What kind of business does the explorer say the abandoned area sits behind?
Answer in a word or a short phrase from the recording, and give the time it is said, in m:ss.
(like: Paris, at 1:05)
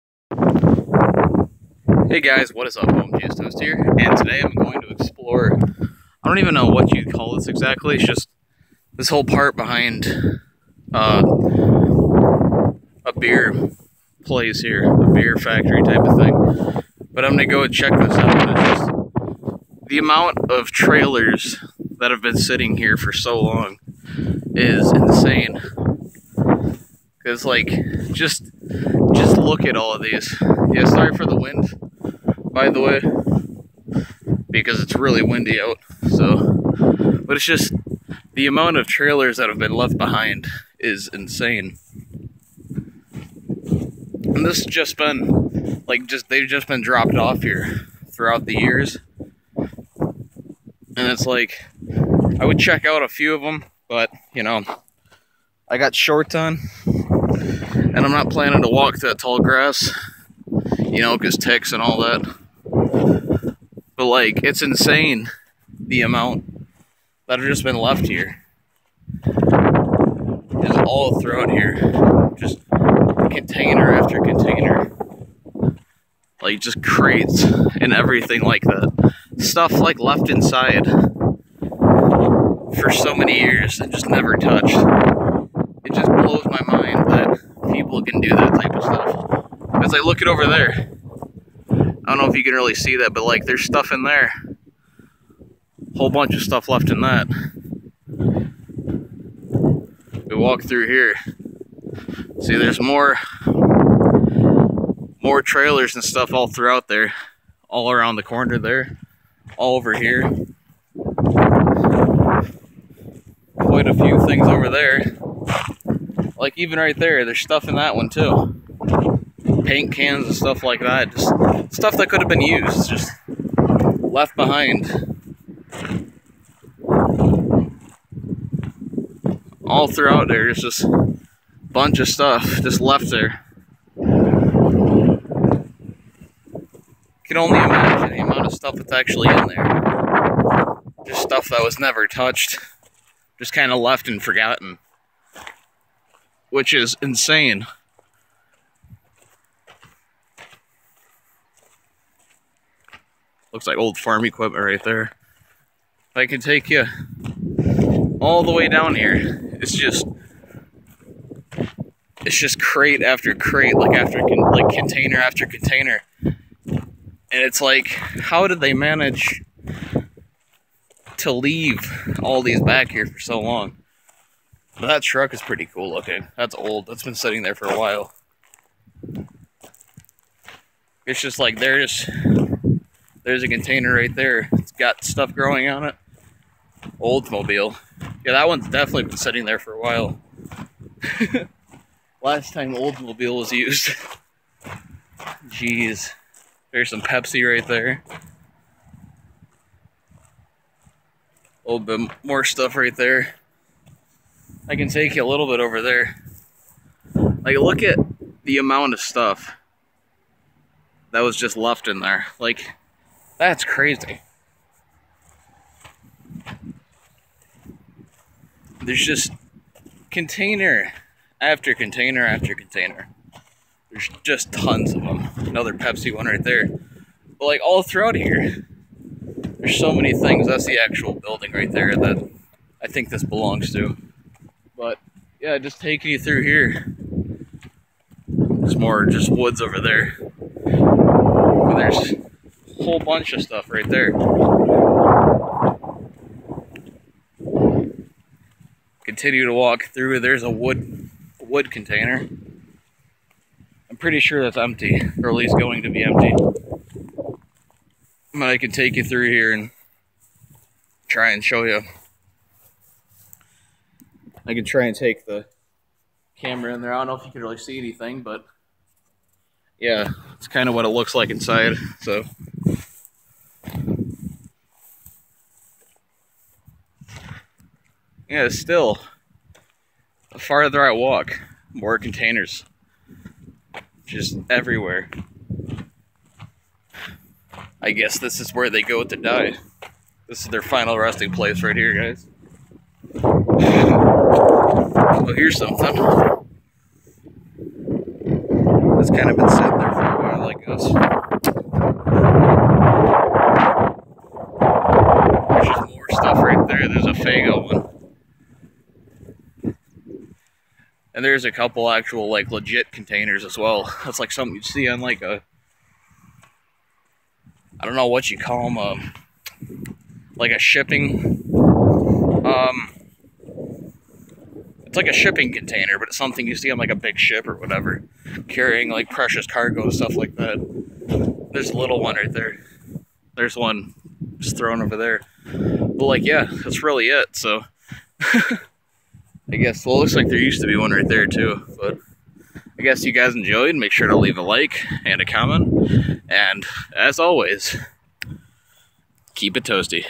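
A beer factory, at 0:14.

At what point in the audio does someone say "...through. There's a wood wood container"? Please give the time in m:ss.
4:09.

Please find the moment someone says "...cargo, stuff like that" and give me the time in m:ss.
5:29.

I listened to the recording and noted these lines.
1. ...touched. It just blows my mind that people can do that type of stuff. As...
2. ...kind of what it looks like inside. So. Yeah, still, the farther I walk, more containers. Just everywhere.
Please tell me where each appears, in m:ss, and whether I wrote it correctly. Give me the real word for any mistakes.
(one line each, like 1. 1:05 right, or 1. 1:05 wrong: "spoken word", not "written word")
1. 1:24 right
2. 4:30 right.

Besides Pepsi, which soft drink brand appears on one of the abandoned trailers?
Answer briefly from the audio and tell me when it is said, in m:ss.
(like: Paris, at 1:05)
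Faygo, at 5:07.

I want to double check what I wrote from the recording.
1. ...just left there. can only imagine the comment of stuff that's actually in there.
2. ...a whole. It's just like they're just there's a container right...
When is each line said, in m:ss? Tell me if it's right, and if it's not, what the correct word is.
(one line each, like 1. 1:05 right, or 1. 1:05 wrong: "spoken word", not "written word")
1. 2:12 wrong: "amount", not "comment"
2. 2:57 wrong: "while", not "whole".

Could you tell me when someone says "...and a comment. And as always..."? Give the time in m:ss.
5:45.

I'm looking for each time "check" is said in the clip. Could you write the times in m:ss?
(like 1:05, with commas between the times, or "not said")
0:17, 0:52.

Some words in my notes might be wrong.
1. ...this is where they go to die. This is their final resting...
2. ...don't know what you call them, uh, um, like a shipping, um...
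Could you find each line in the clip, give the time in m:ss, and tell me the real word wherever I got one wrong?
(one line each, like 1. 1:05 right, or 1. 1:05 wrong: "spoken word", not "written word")
1. 4:48 right
2. 5:17 right.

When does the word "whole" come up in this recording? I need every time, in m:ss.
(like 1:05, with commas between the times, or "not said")
0:09, 1:35, 4:02.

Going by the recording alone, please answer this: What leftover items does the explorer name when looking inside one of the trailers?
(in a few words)
Paint cans.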